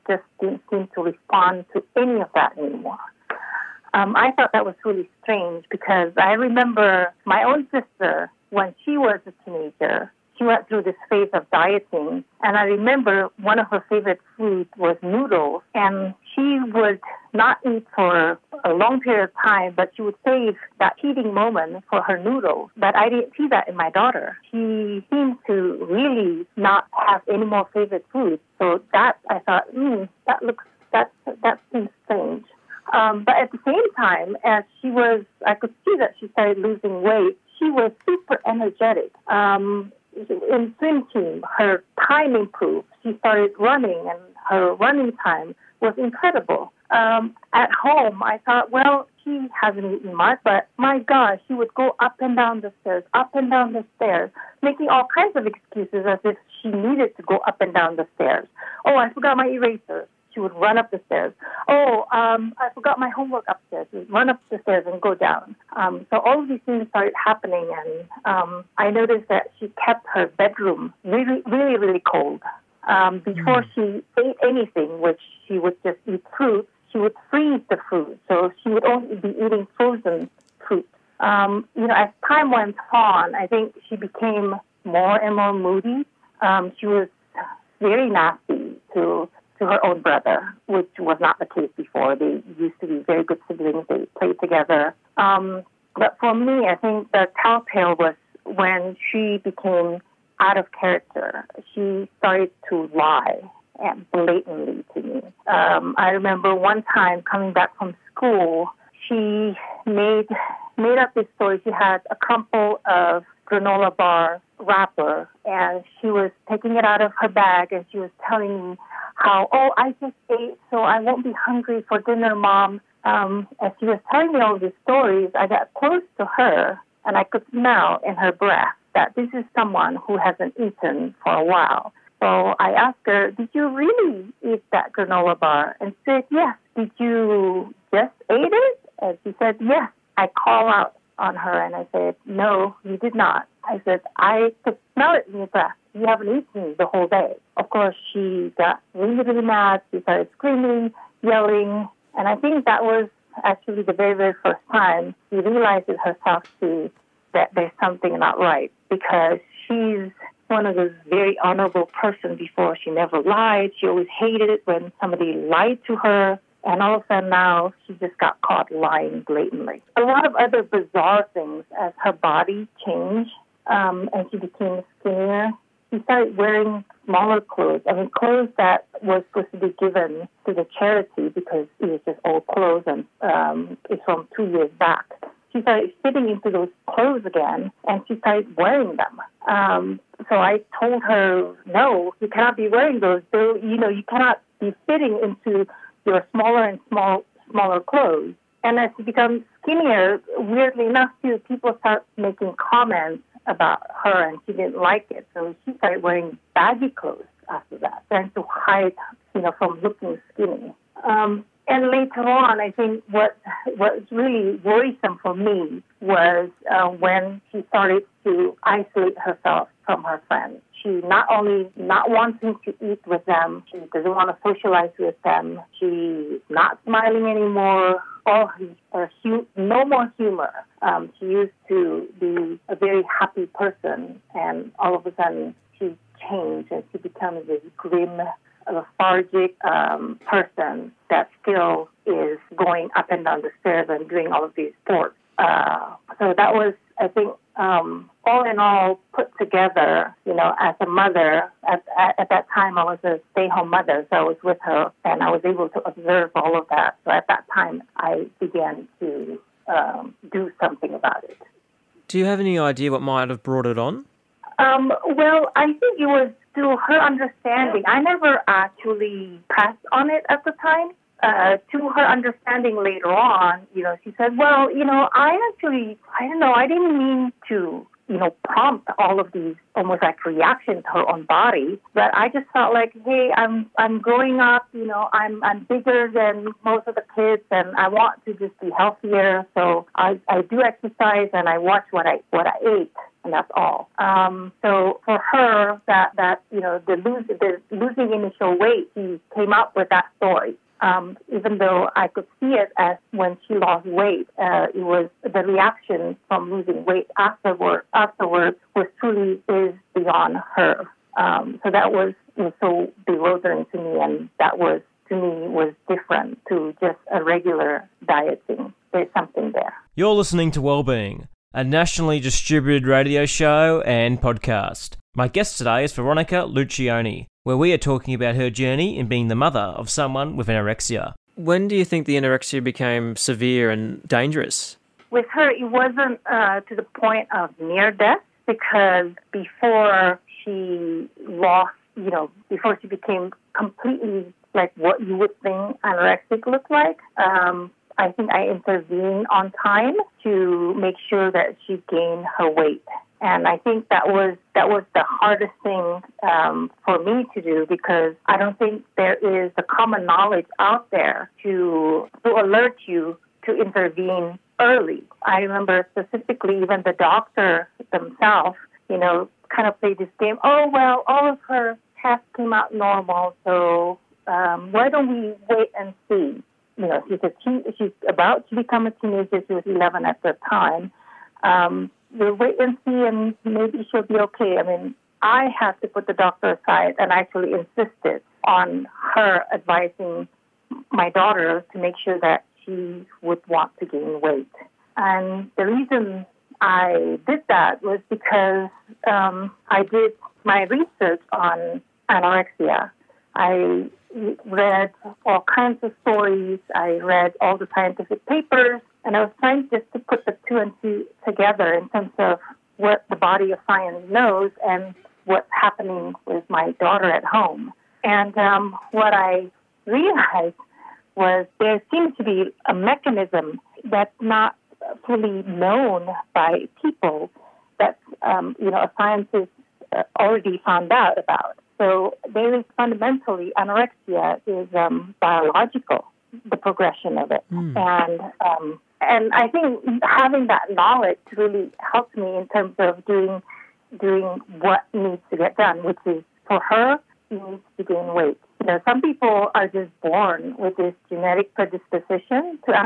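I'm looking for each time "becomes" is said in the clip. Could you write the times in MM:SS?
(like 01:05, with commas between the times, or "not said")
03:19, 03:56, 06:18.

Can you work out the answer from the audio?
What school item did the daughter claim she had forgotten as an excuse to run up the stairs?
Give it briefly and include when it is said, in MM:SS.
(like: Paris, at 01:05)
Eraser, at 00:59.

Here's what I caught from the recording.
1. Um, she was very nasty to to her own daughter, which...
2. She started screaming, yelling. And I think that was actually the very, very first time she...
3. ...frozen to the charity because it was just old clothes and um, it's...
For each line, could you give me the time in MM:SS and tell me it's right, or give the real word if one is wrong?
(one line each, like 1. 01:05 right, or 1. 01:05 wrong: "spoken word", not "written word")
1. 01:26 wrong: "brother", not "daughter"
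2. 02:29 right
3. 02:59 wrong: "given", not "frozen".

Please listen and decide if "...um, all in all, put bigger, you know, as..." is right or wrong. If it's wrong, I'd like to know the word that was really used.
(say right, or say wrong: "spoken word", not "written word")
wrong: "together", not "bigger".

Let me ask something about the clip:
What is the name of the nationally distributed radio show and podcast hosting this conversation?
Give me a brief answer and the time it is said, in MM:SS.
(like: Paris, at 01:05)
Wellbeing, at 05:20.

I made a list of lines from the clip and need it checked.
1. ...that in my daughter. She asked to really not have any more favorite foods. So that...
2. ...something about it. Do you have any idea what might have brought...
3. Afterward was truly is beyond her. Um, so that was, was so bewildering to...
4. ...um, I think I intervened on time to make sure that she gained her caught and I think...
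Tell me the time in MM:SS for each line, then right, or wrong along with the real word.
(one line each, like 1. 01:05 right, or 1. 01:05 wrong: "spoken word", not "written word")
1. 00:23 wrong: "seemed", not "asked"
2. 04:20 right
3. 05:07 right
4. 05:47 wrong: "weight", not "caught".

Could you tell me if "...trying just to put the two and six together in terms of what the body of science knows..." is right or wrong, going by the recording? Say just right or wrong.
wrong.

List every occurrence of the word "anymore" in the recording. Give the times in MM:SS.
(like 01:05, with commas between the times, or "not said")
00:02, 03:47.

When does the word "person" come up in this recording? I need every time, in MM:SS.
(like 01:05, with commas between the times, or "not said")
02:41, 03:53, 04:00.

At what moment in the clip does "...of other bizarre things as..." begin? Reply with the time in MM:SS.
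02:50.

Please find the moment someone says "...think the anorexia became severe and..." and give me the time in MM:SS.
05:31.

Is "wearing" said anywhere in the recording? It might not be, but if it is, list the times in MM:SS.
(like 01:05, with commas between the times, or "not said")
02:56, 03:08, 03:12, 03:26.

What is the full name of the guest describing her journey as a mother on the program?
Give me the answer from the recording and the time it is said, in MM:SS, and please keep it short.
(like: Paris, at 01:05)
Veronica Luccioni, at 05:25.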